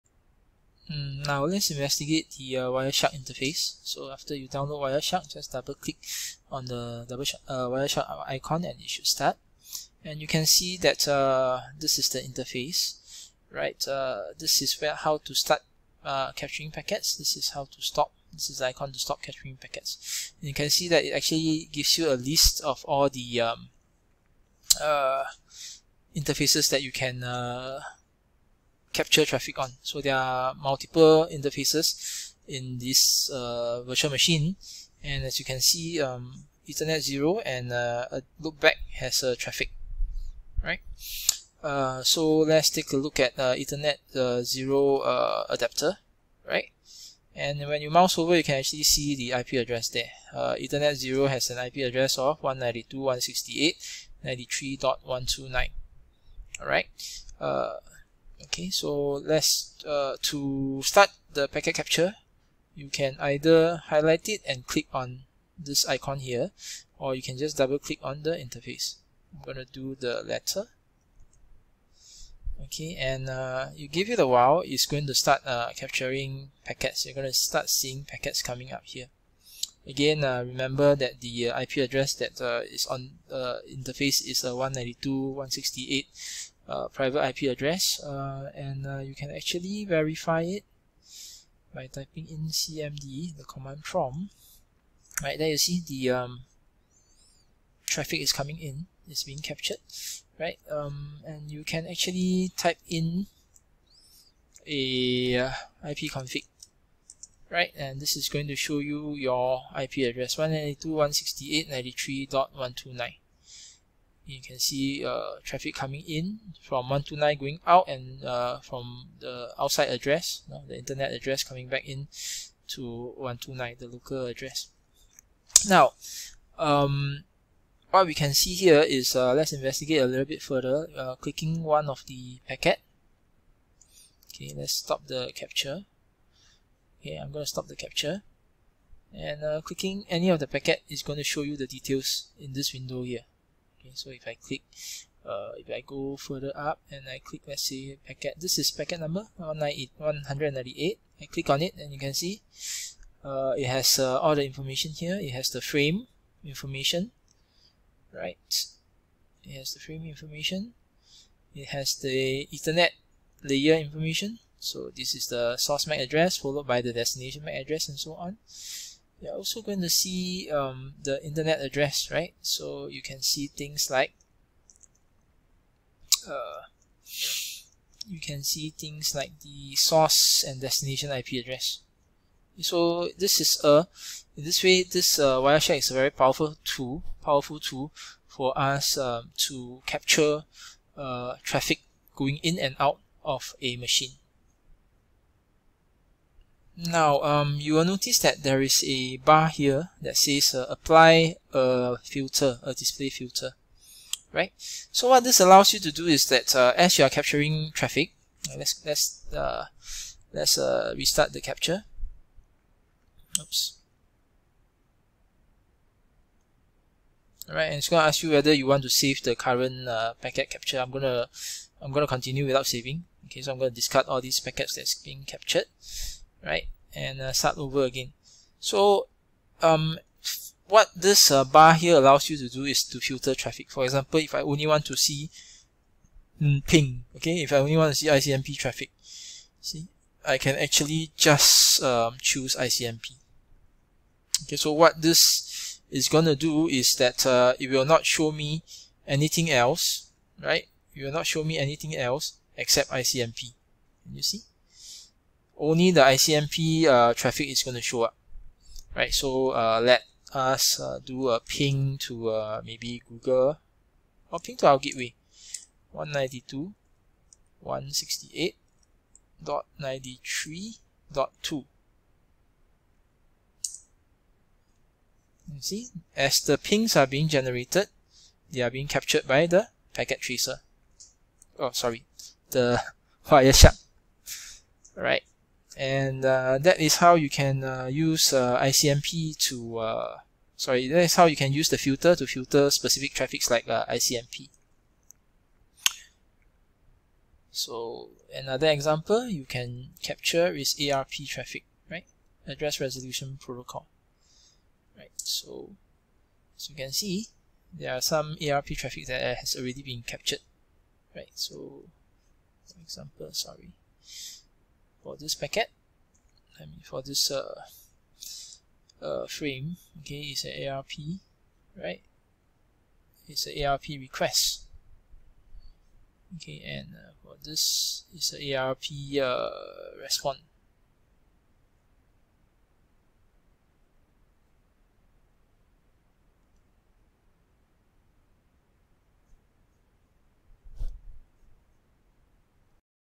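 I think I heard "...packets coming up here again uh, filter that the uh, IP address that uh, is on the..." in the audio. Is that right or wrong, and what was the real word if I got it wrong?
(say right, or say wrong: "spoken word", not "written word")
wrong: "remember", not "filter".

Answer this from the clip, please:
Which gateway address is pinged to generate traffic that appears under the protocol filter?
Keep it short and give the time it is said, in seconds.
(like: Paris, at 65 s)
192.168.93.2, at 265 s.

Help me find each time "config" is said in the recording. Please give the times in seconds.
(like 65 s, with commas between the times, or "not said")
106 s.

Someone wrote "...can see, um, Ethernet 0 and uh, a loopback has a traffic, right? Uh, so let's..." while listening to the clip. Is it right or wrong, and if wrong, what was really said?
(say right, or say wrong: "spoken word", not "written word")
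right.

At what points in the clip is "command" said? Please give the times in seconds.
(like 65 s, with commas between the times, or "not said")
93 s.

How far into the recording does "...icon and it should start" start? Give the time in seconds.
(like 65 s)
8 s.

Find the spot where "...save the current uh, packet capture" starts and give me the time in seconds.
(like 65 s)
218 s.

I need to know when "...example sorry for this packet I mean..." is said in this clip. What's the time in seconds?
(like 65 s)
312 s.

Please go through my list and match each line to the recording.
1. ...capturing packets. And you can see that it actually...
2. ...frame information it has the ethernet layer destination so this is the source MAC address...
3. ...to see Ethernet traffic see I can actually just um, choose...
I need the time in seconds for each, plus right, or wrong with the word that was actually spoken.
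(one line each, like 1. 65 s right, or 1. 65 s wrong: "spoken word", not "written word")
1. 19 s right
2. 159 s wrong: "information", not "destination"
3. 237 s wrong: "ICMP", not "Ethernet".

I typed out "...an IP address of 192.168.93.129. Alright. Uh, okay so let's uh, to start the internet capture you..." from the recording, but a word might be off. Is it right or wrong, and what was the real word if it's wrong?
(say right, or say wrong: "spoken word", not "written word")
wrong: "packet", not "internet".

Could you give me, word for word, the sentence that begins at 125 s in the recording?
Now, um, what we can see here is, uh, let's investigate a little bit further, uh, clicking one of the packet.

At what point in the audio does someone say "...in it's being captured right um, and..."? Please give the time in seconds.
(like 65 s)
98 s.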